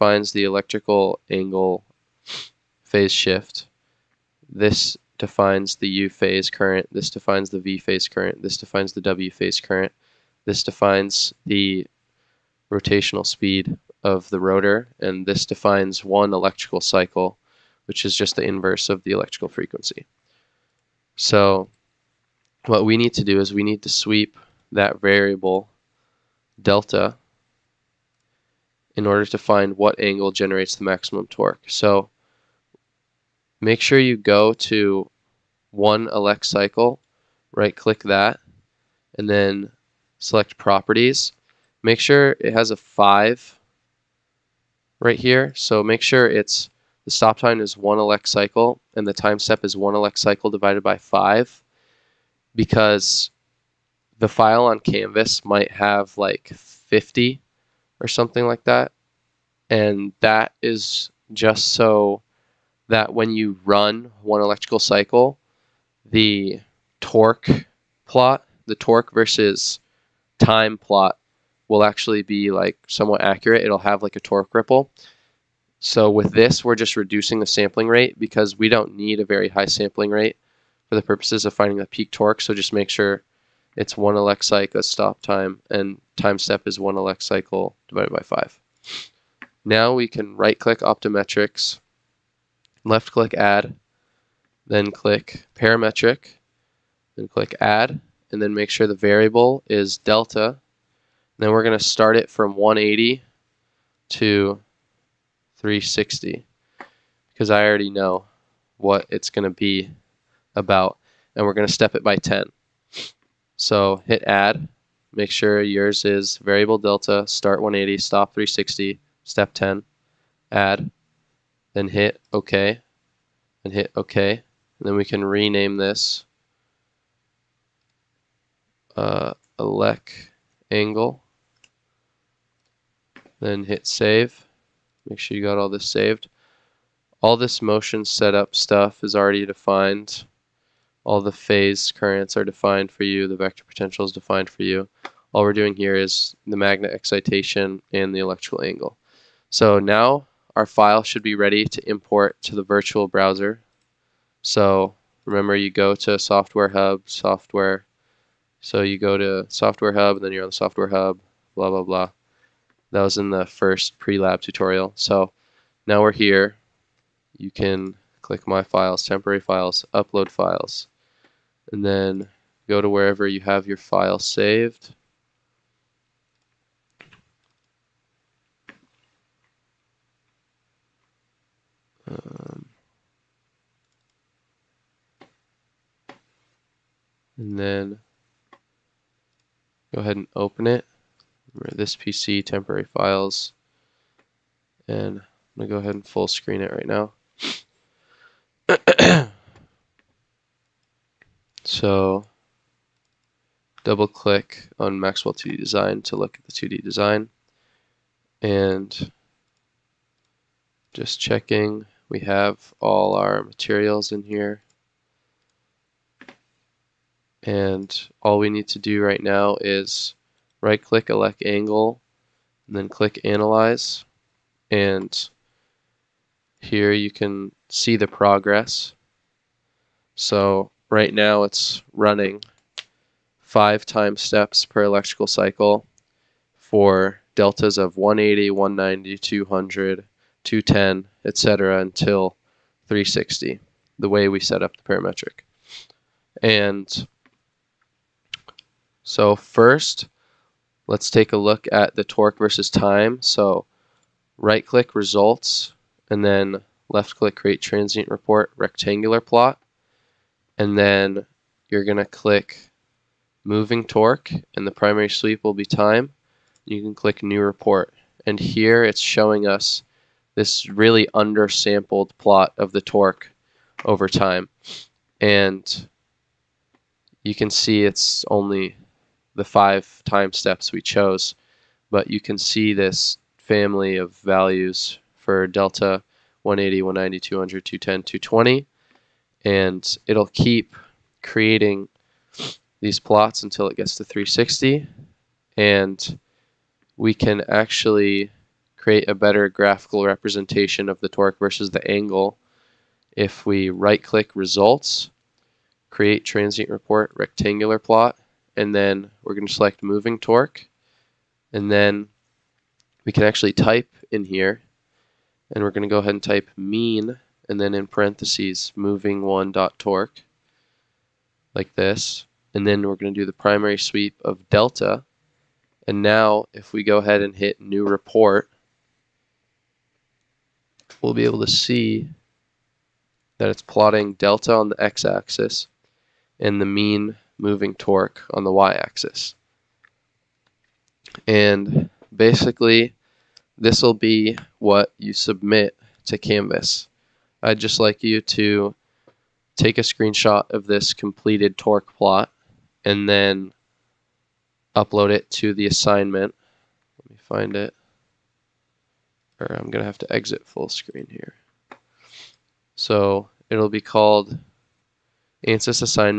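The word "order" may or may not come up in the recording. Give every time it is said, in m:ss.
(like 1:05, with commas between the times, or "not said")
0:29.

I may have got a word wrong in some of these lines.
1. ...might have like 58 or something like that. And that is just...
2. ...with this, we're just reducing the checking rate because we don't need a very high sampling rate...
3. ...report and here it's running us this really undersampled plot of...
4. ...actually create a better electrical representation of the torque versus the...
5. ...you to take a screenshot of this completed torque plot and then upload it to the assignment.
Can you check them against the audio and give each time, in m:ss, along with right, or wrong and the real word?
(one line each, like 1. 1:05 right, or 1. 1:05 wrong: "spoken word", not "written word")
1. 0:55 wrong: "50", not "58"
2. 1:16 wrong: "sampling", not "checking"
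3. 4:27 wrong: "showing", not "running"
4. 4:57 wrong: "graphical", not "electrical"
5. 5:48 right.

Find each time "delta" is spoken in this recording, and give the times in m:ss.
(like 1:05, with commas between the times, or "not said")
0:26, 1:39, 1:56, 3:57, 4:45, 5:24, 5:34.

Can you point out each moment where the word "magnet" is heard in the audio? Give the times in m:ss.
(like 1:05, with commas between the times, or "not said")
2:26.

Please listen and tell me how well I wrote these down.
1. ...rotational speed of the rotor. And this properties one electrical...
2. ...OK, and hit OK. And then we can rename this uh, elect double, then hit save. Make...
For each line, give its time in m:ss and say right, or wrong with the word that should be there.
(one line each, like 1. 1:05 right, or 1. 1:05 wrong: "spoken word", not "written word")
1. 0:12 wrong: "defines", not "properties"
2. 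2:02 wrong: "angle", not "double".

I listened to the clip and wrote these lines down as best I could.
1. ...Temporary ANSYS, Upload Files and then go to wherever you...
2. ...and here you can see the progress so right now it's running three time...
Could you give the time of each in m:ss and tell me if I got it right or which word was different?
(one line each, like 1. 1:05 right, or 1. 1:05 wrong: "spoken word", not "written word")
1. 2:49 wrong: "Files", not "ANSYS"
2. 3:44 wrong: "five", not "three".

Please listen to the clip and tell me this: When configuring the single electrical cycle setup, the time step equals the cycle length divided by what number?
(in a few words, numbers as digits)
5.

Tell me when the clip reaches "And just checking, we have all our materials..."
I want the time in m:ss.
3:28.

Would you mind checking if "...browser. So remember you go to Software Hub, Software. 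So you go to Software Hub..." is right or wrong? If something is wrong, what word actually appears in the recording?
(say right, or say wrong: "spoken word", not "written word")
right.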